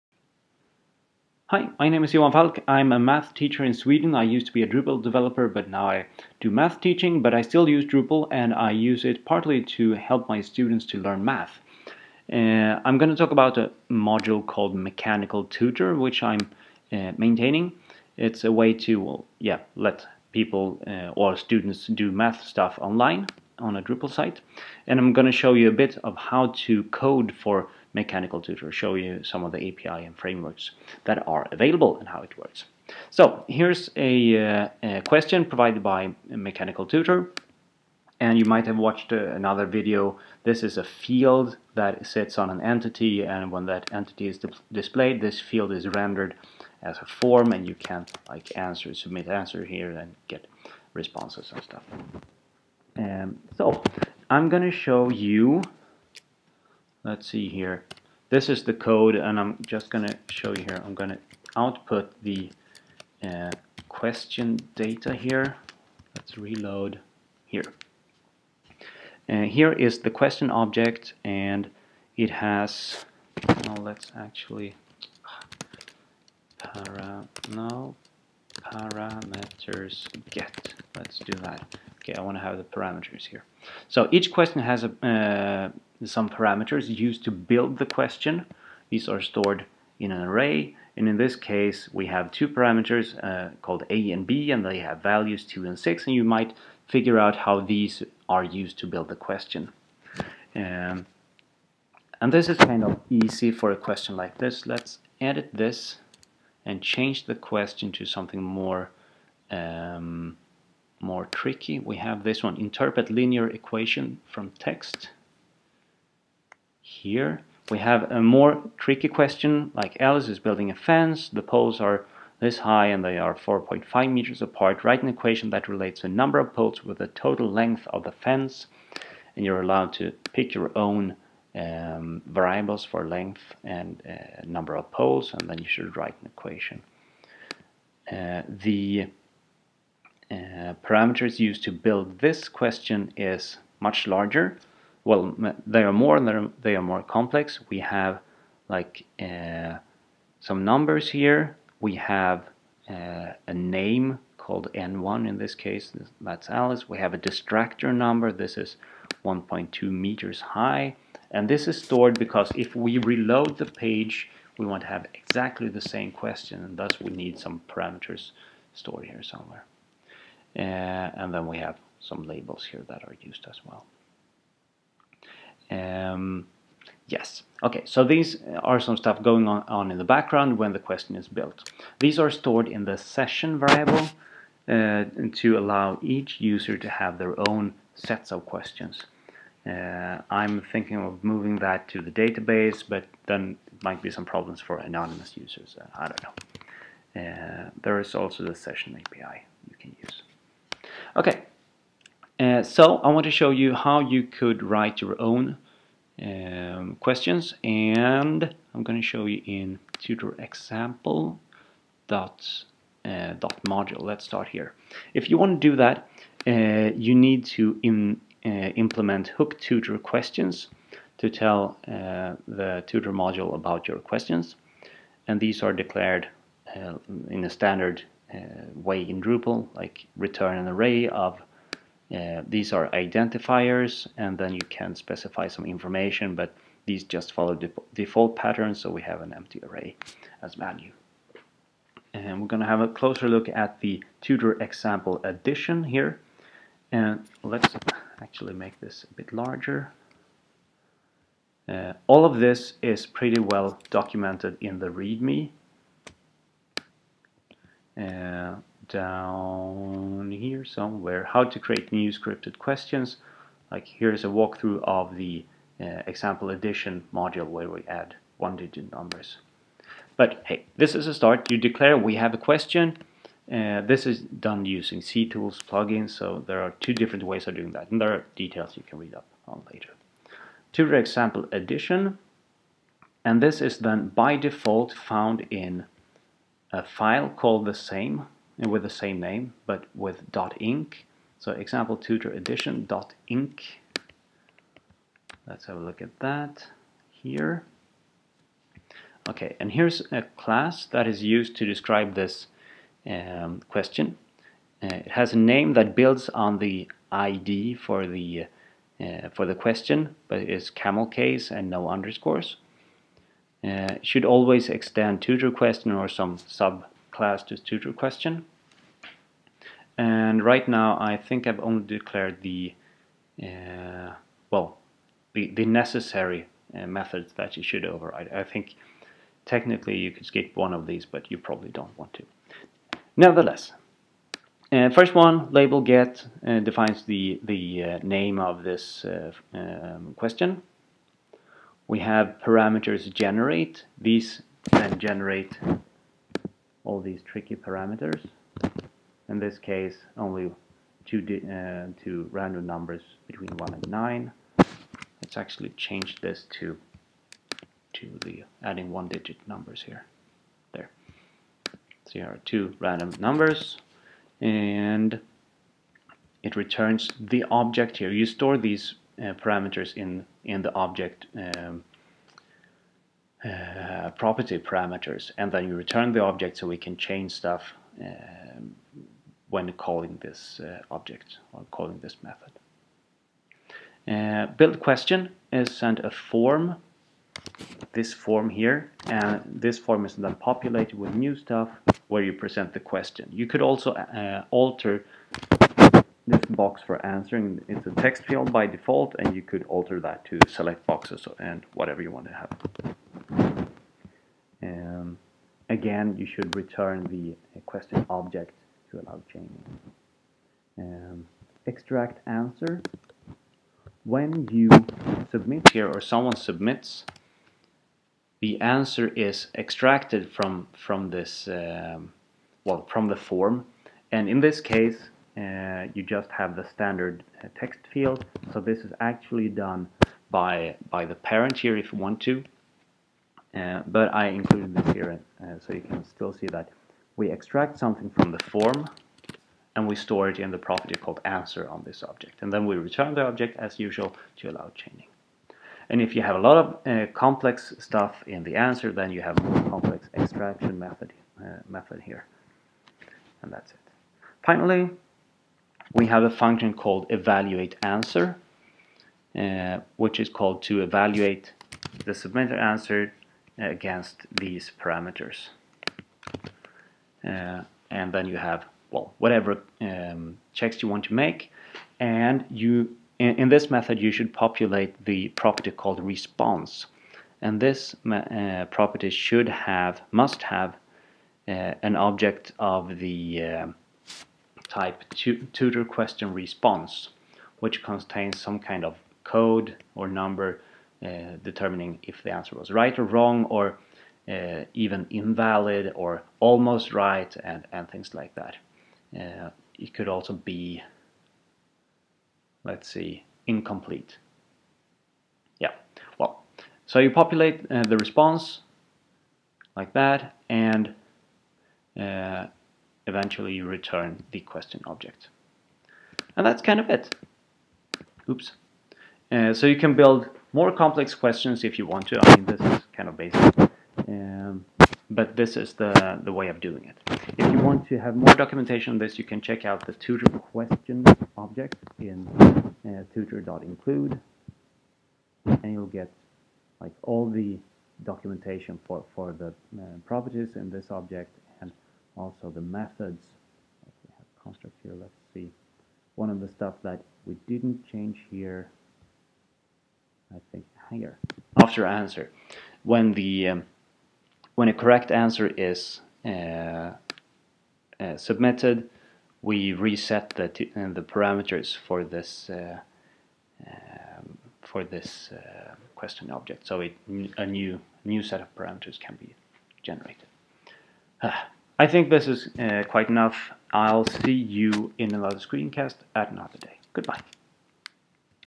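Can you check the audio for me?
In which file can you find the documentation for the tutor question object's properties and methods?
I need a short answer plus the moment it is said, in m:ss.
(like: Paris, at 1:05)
tutor.include, at 8:53.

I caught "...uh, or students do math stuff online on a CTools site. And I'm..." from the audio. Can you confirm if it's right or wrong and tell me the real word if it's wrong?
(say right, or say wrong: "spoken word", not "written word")
wrong: "Drupal", not "CTools".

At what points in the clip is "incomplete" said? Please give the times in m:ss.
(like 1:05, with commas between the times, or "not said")
8:23.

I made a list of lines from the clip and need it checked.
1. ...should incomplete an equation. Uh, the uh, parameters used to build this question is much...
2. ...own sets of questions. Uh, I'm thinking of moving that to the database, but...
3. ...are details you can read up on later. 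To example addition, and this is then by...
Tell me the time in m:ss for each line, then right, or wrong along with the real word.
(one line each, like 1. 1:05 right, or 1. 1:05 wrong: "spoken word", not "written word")
1. 2:15 wrong: "write", not "incomplete"
2. 3:07 right
3. 4:38 right.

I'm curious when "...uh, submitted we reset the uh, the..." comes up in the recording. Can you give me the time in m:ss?
9:17.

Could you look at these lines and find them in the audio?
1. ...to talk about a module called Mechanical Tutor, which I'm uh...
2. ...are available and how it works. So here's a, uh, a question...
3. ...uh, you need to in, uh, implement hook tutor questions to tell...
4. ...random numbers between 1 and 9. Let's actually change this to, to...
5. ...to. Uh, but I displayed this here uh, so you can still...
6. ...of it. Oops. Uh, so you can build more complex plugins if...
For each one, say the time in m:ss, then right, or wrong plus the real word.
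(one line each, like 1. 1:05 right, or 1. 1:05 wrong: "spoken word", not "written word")
1. 0:13 right
2. 0:31 right
3. 3:36 right
4. 5:52 right
5. 7:12 wrong: "included", not "displayed"
6. 8:36 wrong: "questions", not "plugins".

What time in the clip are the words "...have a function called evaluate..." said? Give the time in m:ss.
7:36.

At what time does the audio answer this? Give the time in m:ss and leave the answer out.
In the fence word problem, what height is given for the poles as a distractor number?
2:39.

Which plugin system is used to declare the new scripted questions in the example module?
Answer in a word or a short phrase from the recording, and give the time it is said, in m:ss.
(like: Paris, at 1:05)
CTools, at 4:34.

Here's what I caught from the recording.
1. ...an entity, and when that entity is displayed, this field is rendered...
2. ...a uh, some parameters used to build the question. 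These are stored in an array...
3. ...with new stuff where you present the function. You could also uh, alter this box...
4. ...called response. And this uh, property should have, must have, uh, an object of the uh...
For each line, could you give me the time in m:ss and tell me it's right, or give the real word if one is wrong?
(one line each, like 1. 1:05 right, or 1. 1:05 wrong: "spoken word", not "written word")
1. 0:42 right
2. 1:24 right
3. 6:30 wrong: "question", not "function"
4. 7:55 right.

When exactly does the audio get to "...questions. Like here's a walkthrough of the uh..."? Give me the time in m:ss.
4:22.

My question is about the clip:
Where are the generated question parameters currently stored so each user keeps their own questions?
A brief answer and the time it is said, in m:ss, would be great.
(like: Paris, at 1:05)
session variable, at 3:02.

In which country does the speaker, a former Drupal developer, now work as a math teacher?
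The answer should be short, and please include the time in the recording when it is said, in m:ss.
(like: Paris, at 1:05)
Sweden, at 0:03.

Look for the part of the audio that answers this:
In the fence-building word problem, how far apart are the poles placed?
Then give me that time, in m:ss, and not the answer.
2:03.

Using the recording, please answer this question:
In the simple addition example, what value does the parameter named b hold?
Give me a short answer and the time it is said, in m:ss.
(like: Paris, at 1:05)
6, at 1:35.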